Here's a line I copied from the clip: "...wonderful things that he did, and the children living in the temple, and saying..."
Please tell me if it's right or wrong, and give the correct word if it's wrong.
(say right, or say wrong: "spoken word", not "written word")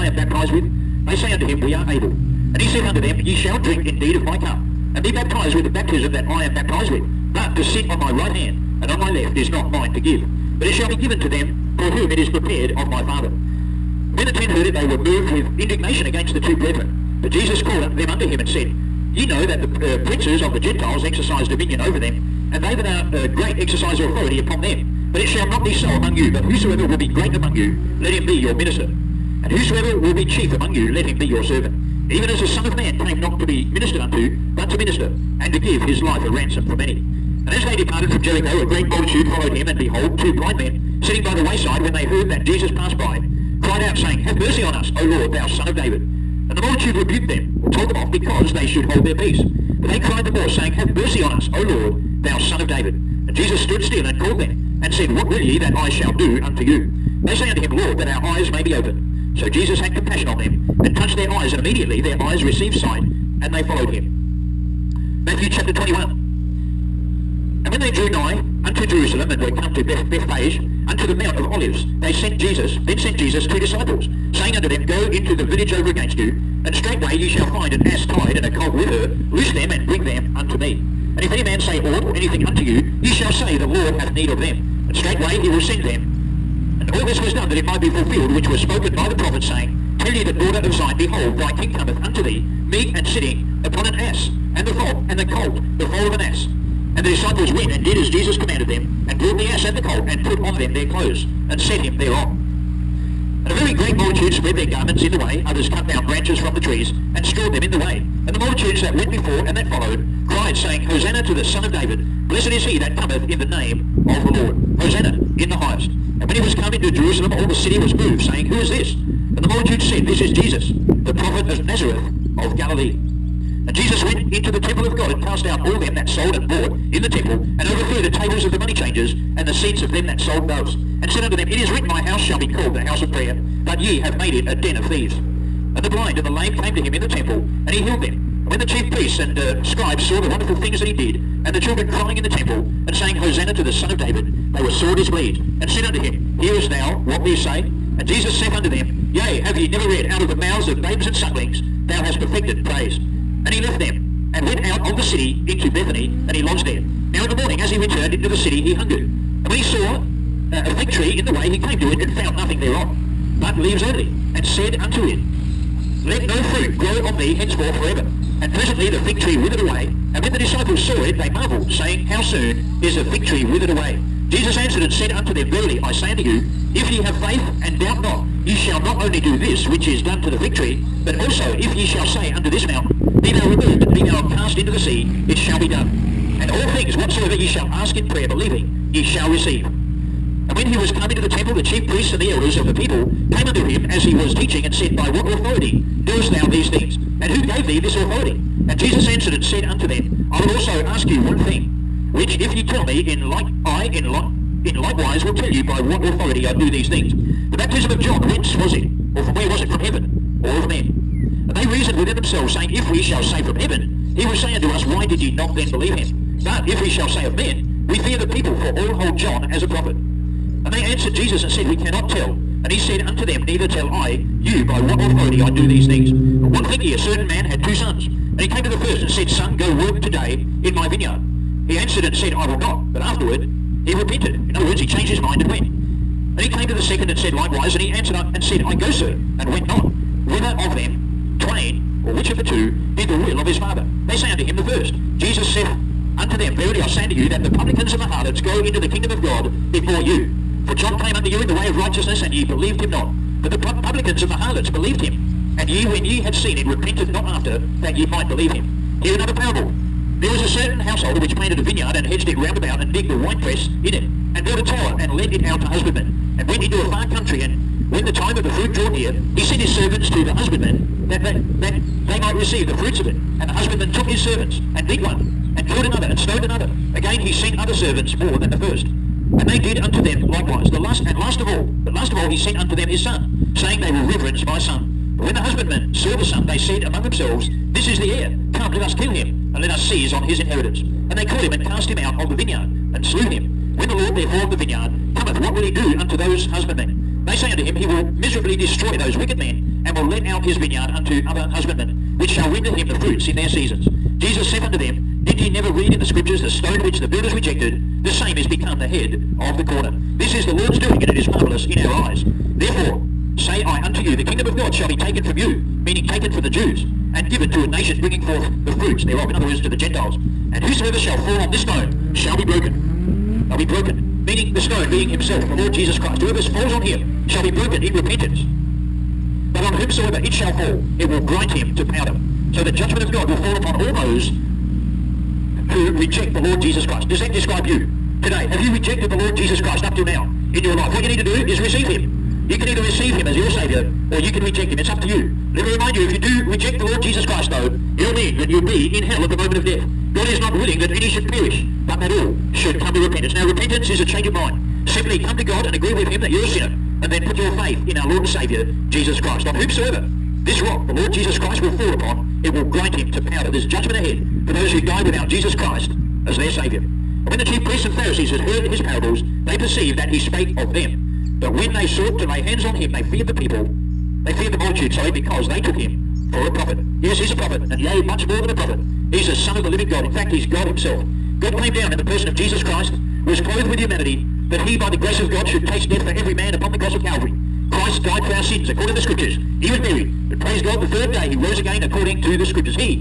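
wrong: "crying", not "living".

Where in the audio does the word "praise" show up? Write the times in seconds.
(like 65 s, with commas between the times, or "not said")
152 s, 390 s.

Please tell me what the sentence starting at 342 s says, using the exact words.
You can either receive him as your Saviour or you can reject him.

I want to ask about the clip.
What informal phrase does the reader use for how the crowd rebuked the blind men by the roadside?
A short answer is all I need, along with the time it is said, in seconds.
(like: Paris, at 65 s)
told them off, at 47 s.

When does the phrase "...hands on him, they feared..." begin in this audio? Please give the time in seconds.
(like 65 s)
372 s.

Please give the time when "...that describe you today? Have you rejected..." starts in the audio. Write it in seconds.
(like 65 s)
337 s.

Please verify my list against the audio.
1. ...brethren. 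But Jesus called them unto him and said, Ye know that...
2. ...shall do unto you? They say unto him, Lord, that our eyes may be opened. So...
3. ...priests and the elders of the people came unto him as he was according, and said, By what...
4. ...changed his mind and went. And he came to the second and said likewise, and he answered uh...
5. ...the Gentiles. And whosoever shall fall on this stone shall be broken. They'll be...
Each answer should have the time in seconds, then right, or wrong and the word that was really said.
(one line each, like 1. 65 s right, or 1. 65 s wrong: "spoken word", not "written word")
1. 16 s right
2. 55 s right
3. 191 s wrong: "teaching", not "according"
4. 234 s right
5. 319 s right.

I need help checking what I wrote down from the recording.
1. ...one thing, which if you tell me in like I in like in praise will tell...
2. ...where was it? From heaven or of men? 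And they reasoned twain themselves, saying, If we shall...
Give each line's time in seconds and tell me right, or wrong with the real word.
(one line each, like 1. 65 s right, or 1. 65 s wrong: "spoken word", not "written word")
1. 201 s wrong: "likewise", not "praise"
2. 209 s wrong: "within", not "twain".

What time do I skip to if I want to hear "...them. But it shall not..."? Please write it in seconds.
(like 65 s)
24 s.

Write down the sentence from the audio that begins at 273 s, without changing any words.
And the husbandman took his servants and beat one, and killed another, and stoned another.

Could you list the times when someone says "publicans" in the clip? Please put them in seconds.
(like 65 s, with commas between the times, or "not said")
247 s, 253 s.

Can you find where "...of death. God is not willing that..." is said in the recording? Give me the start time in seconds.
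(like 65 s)
349 s.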